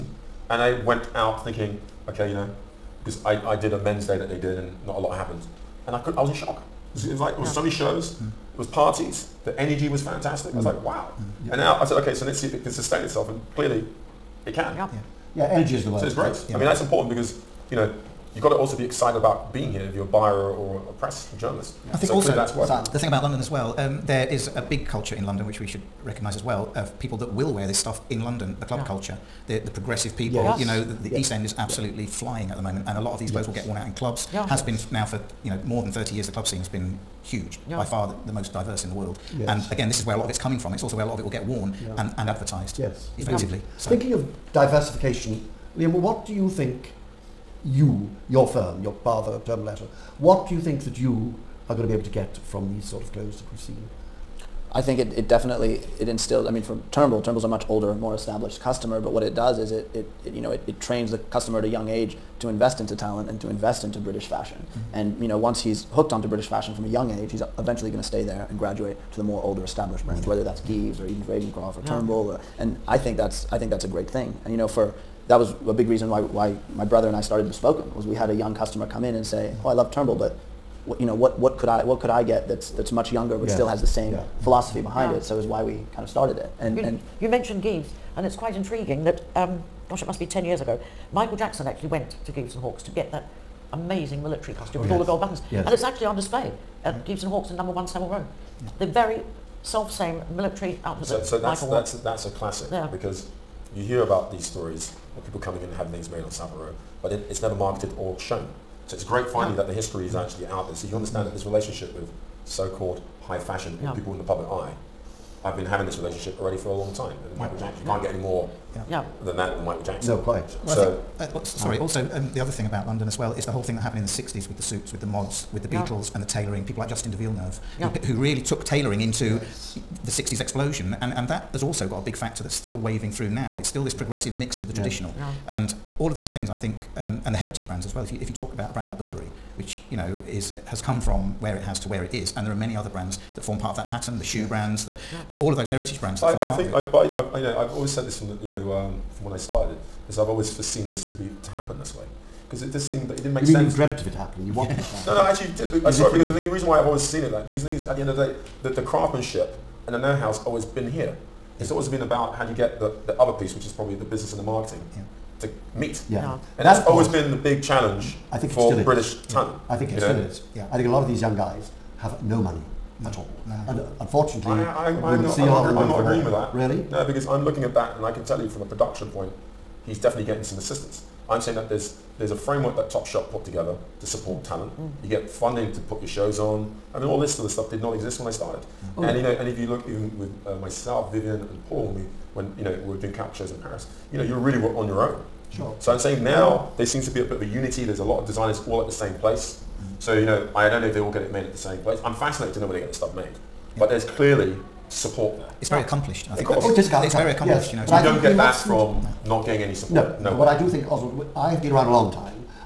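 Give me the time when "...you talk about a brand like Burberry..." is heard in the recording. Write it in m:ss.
2:18.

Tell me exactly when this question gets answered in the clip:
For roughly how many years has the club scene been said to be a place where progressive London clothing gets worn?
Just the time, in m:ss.
0:35.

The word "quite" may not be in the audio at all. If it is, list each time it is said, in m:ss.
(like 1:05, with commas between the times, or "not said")
1:28, 2:00.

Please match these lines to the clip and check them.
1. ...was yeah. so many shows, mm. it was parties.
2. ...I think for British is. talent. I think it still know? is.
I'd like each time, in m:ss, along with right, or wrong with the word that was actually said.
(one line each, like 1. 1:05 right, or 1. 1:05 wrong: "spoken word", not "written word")
1. 0:07 right
2. 2:48 right.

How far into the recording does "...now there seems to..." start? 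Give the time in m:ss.
3:16.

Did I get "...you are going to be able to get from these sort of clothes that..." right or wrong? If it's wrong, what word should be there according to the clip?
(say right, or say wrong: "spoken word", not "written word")
right.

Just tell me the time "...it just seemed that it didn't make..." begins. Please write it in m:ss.
2:32.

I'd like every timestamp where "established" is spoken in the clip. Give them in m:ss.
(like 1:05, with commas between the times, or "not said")
0:58, 1:09.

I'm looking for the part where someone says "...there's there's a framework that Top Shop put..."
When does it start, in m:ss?
3:01.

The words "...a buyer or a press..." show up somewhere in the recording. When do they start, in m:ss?
0:20.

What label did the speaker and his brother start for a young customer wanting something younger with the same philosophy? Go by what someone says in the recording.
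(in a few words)
Bespoken.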